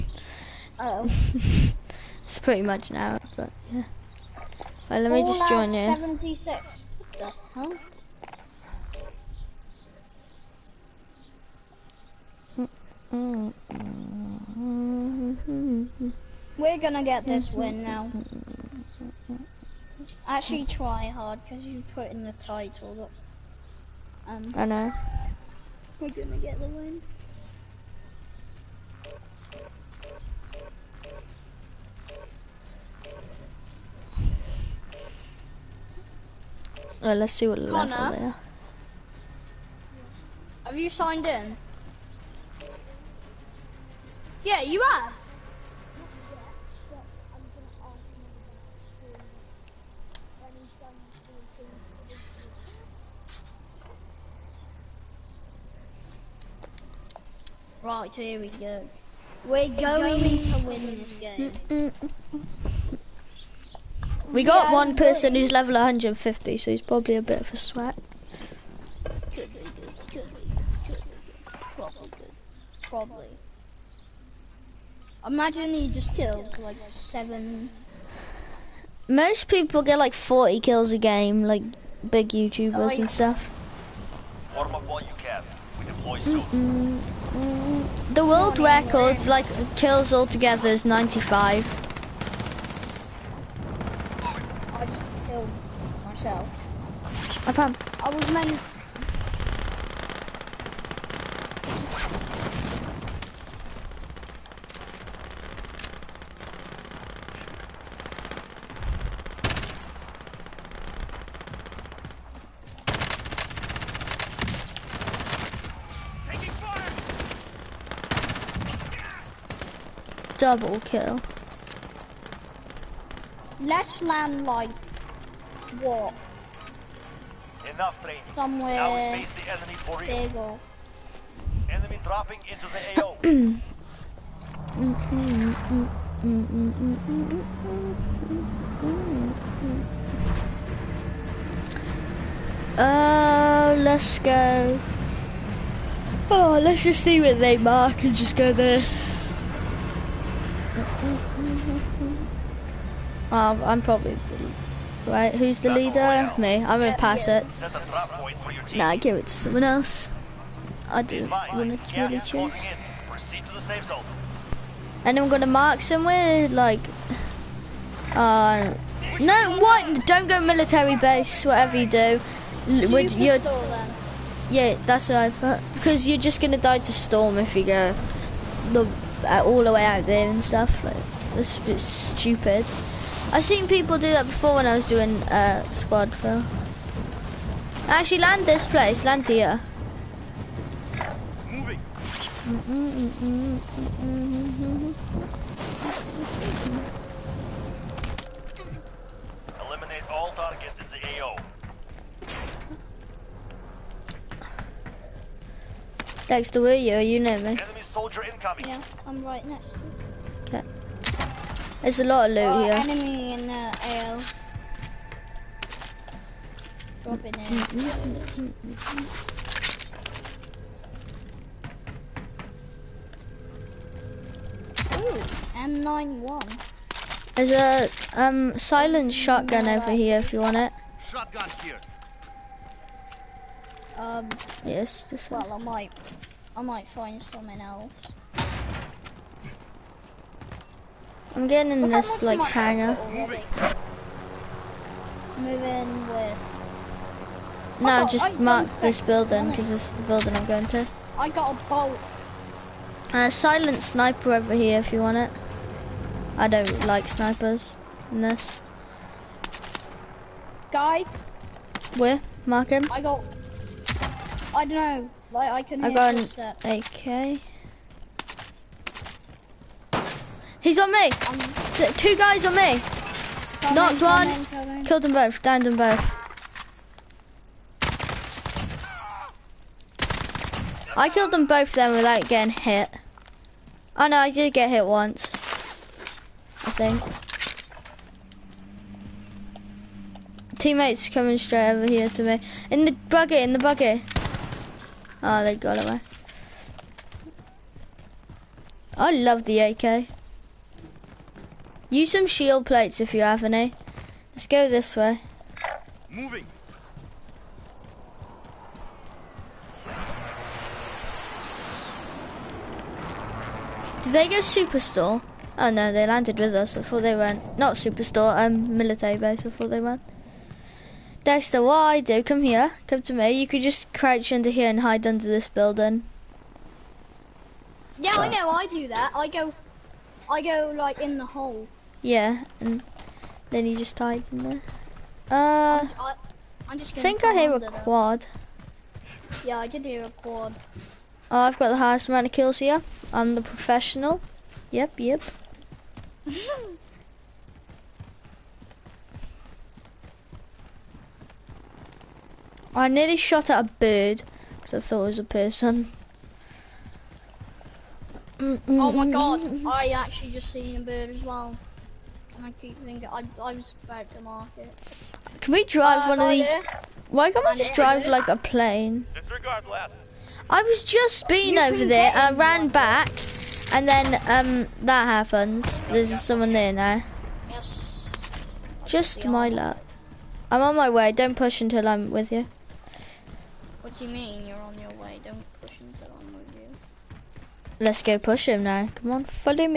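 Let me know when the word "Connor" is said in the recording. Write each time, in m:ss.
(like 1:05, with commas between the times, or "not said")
0:37.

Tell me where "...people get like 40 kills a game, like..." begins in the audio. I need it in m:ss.
1:19.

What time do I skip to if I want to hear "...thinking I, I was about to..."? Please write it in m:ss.
6:02.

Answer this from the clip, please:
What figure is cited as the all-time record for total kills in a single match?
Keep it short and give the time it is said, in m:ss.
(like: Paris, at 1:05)
95, at 1:30.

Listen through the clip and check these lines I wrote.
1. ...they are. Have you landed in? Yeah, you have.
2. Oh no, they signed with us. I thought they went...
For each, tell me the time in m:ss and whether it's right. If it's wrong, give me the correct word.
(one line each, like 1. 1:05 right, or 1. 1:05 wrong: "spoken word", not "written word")
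1. 0:38 wrong: "signed", not "landed"
2. 5:15 wrong: "landed", not "signed".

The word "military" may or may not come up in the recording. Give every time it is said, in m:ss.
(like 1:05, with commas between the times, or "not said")
2:50, 5:18.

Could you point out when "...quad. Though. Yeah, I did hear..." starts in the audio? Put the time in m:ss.
5:37.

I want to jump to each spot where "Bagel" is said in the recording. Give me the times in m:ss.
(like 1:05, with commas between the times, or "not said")
2:10.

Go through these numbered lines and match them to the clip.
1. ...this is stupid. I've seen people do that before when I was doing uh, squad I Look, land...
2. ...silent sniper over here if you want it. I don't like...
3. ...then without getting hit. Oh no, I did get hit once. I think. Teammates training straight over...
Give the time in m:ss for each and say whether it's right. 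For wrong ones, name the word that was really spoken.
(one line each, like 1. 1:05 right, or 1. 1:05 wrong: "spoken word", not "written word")
1. 3:01 wrong: "Actually", not "Look"
2. 4:13 right
3. 4:41 wrong: "coming", not "training".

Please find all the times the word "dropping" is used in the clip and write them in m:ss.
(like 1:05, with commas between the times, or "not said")
2:12, 3:37.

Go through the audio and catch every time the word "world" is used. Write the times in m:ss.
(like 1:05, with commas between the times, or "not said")
1:28.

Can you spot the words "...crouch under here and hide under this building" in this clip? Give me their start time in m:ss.
5:23.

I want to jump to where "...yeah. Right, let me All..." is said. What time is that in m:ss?
0:03.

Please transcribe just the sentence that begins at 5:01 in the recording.
Use some shield plates if you have any.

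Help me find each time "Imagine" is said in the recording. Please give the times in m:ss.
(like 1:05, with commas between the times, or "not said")
1:15.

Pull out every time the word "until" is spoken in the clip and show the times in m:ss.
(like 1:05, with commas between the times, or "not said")
6:21, 6:25.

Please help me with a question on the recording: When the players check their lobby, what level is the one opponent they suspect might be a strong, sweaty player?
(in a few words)
150.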